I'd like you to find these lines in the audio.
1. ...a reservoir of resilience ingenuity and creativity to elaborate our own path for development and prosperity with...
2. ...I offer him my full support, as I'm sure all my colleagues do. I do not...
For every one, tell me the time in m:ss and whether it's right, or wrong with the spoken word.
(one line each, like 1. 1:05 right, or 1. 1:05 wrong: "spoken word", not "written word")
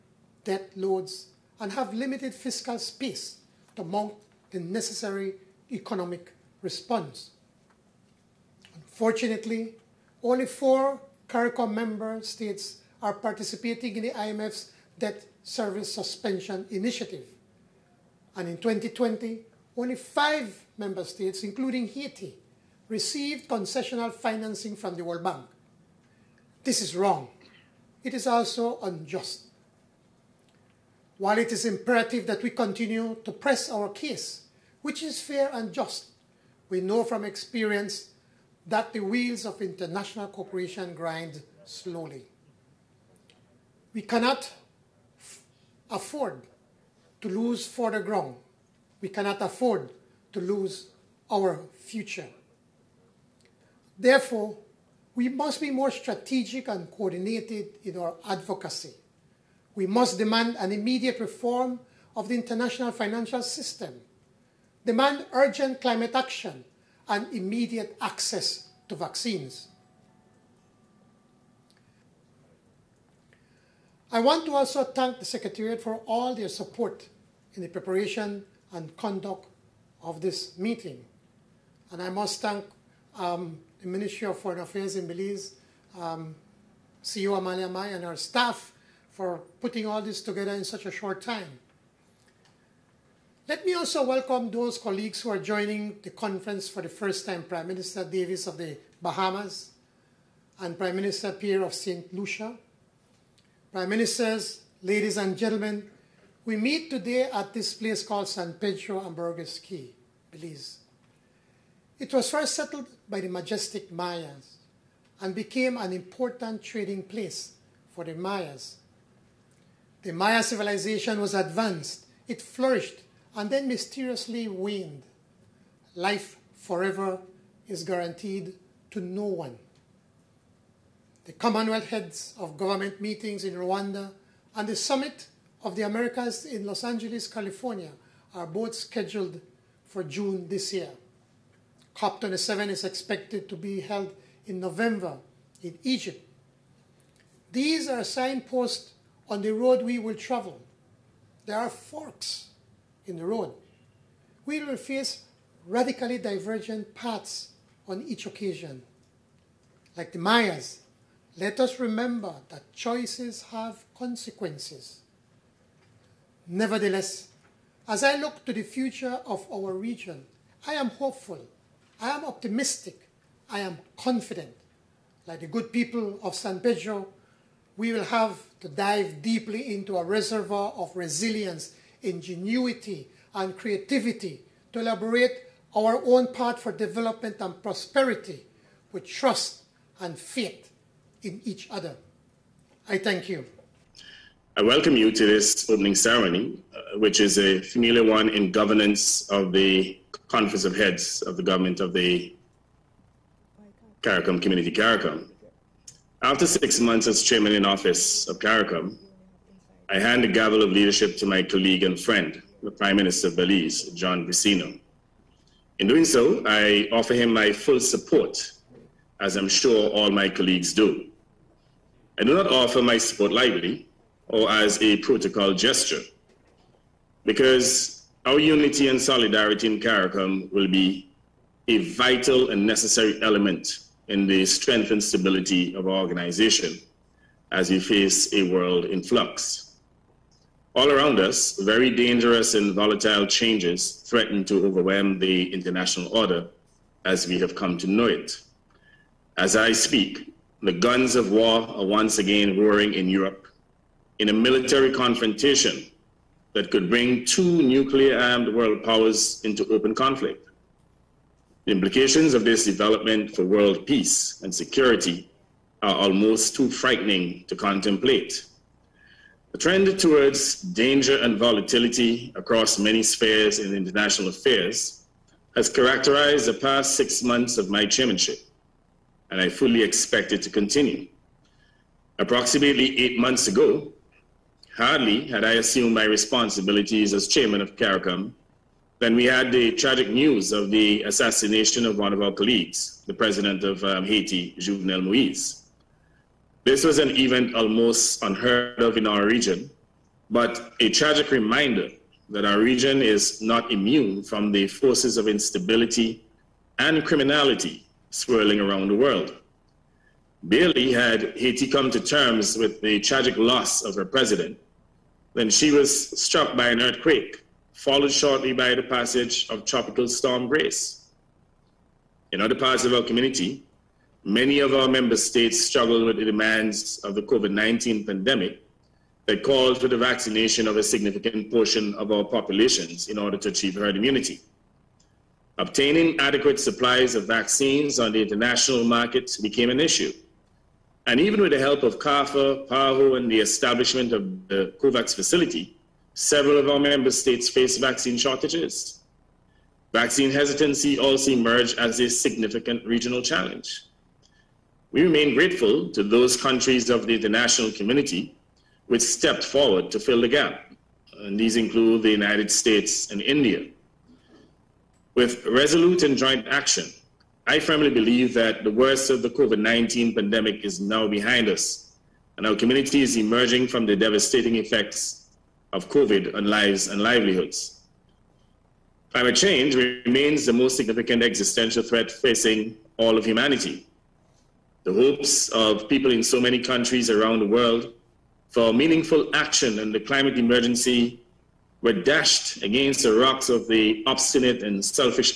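1. 2:59 right
2. 3:36 right.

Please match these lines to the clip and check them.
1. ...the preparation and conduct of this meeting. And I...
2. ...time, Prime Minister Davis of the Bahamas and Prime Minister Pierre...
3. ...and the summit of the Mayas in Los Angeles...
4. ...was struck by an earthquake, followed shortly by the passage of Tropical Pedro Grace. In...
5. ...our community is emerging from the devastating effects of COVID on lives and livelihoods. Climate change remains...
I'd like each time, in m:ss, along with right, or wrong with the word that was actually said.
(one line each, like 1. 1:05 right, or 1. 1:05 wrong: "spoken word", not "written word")
1. 1:17 right
2. 1:37 right
3. 2:14 wrong: "Americas", not "Mayas"
4. 5:15 wrong: "Storm", not "Pedro"
5. 6:12 right.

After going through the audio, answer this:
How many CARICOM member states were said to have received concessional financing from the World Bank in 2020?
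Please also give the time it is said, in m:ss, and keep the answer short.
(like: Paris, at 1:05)
5, at 0:19.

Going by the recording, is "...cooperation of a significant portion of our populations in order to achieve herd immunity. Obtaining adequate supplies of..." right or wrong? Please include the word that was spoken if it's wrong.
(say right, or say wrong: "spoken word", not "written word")
wrong: "vaccination", not "cooperation".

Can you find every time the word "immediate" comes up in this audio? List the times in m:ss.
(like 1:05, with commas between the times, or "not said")
1:00, 1:07.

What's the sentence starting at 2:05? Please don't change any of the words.
Life forever is guaranteed to no one.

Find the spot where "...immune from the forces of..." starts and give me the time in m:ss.
5:03.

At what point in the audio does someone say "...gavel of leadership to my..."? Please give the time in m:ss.
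3:30.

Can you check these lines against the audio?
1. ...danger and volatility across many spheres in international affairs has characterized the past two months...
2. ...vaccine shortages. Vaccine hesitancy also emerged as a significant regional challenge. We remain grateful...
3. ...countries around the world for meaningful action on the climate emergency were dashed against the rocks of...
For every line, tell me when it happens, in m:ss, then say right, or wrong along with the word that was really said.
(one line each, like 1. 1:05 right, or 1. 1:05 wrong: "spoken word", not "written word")
1. 4:30 wrong: "six", not "two"
2. 5:47 right
3. 6:26 right.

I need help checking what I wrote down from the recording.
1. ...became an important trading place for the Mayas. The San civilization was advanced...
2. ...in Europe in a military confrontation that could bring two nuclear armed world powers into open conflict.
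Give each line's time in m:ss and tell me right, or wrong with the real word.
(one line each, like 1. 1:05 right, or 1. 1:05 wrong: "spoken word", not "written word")
1. 1:55 wrong: "Maya", not "San"
2. 4:12 right.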